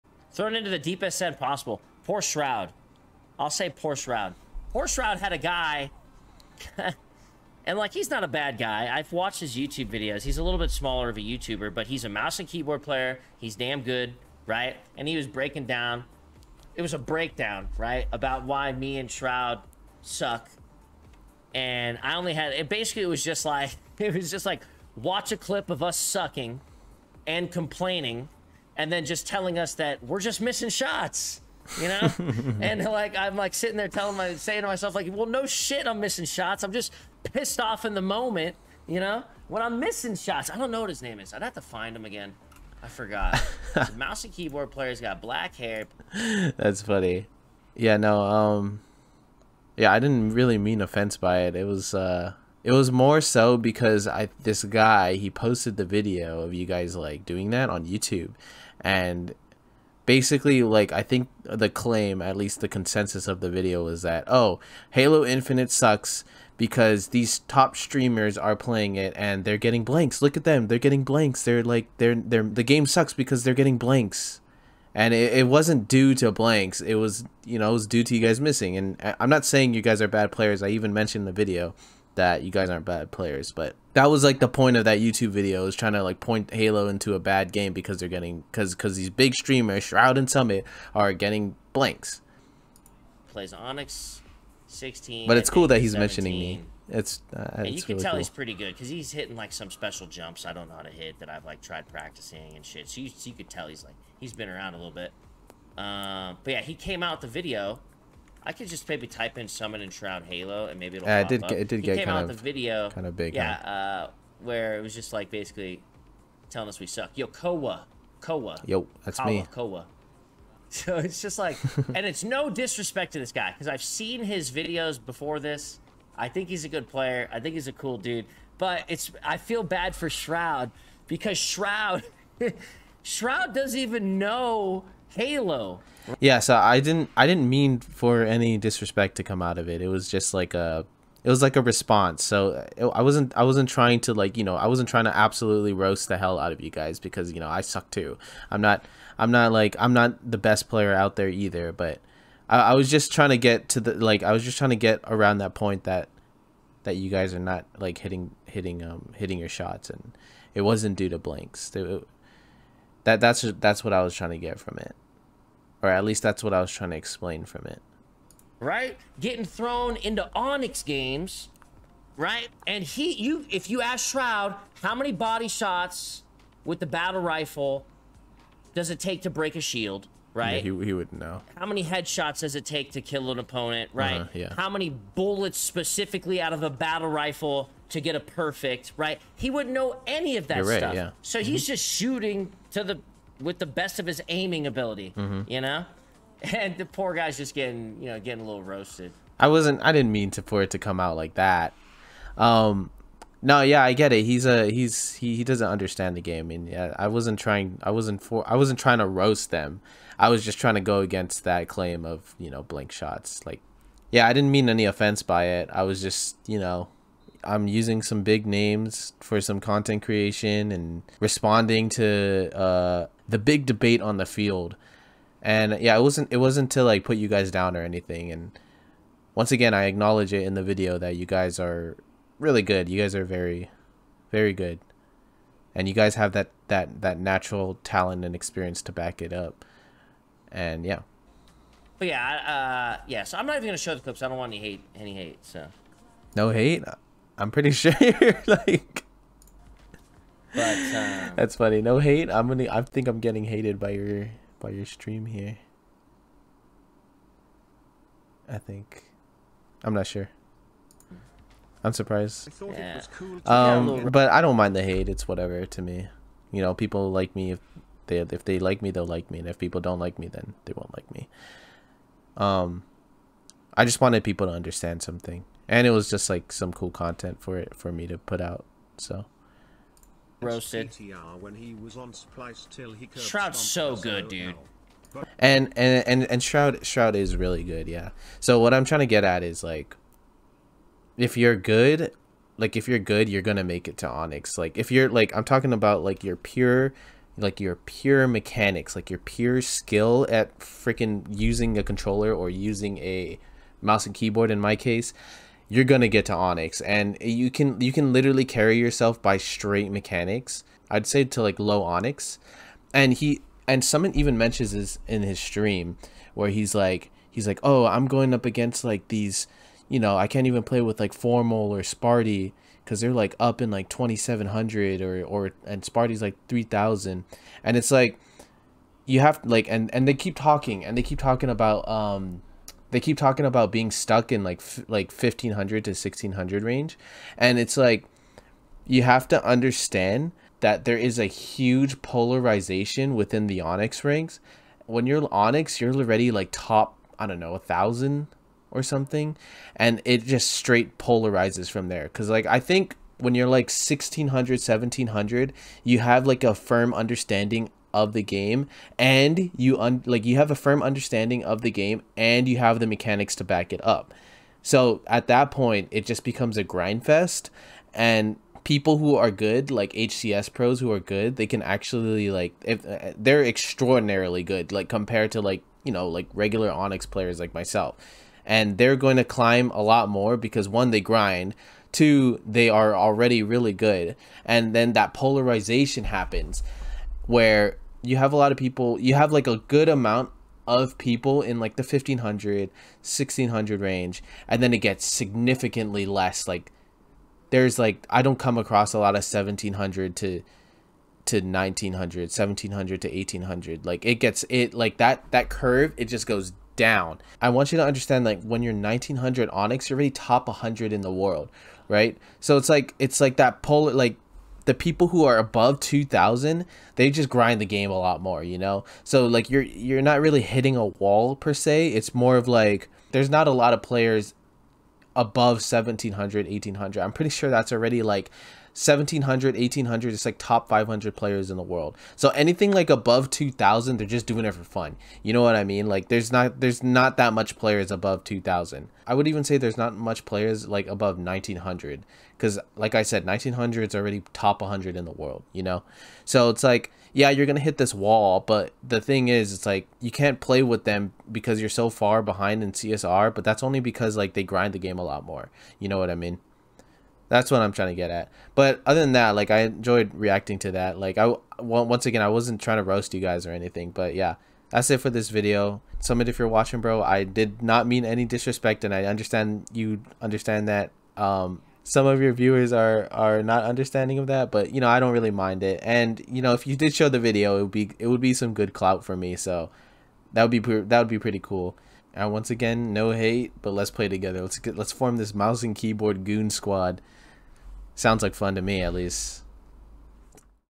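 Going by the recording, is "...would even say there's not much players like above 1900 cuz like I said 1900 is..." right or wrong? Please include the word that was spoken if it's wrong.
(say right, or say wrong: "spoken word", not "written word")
right.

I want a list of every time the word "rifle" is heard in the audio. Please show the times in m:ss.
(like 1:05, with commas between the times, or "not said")
2:57, 3:07.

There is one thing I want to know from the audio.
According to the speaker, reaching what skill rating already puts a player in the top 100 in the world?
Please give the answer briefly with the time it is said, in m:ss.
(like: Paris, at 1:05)
1900, at 6:48.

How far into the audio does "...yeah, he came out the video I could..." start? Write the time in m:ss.
1:46.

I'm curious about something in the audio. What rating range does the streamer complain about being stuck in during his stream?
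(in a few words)
1500 to 1600.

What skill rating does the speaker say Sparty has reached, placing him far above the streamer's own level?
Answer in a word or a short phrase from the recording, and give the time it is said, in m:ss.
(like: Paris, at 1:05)
3000, at 5:26.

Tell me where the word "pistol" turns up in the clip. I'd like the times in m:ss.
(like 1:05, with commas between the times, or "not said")
not said.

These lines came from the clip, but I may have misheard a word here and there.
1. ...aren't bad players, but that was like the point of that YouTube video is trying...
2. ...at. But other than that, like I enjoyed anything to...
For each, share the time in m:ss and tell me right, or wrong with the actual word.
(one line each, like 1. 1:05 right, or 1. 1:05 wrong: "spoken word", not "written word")
1. 1:22 right
2. 7:38 wrong: "reacting", not "anything".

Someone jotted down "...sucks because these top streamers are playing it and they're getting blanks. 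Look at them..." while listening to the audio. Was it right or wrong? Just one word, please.
right.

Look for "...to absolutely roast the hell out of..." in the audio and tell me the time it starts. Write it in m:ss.
2:25.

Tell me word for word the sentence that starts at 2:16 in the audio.
Yeah, so I didn't I didn't mean for any disrespect to come out of it.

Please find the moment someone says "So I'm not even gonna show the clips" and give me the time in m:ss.
4:03.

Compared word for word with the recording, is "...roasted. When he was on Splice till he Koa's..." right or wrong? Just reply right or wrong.
wrong.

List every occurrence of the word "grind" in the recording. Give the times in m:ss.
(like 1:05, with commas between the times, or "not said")
6:06, 6:21, 6:57, 7:34.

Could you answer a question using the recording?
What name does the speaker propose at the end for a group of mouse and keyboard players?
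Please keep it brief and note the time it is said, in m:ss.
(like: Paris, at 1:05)
goon squad, at 8:06.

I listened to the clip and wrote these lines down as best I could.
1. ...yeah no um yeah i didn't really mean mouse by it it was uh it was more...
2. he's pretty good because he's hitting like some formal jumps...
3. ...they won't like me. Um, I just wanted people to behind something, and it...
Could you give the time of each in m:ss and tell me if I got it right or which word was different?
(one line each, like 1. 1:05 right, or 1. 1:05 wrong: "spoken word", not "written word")
1. 0:47 wrong: "offense", not "mouse"
2. 1:38 wrong: "special", not "formal"
3. 4:30 wrong: "understand", not "behind".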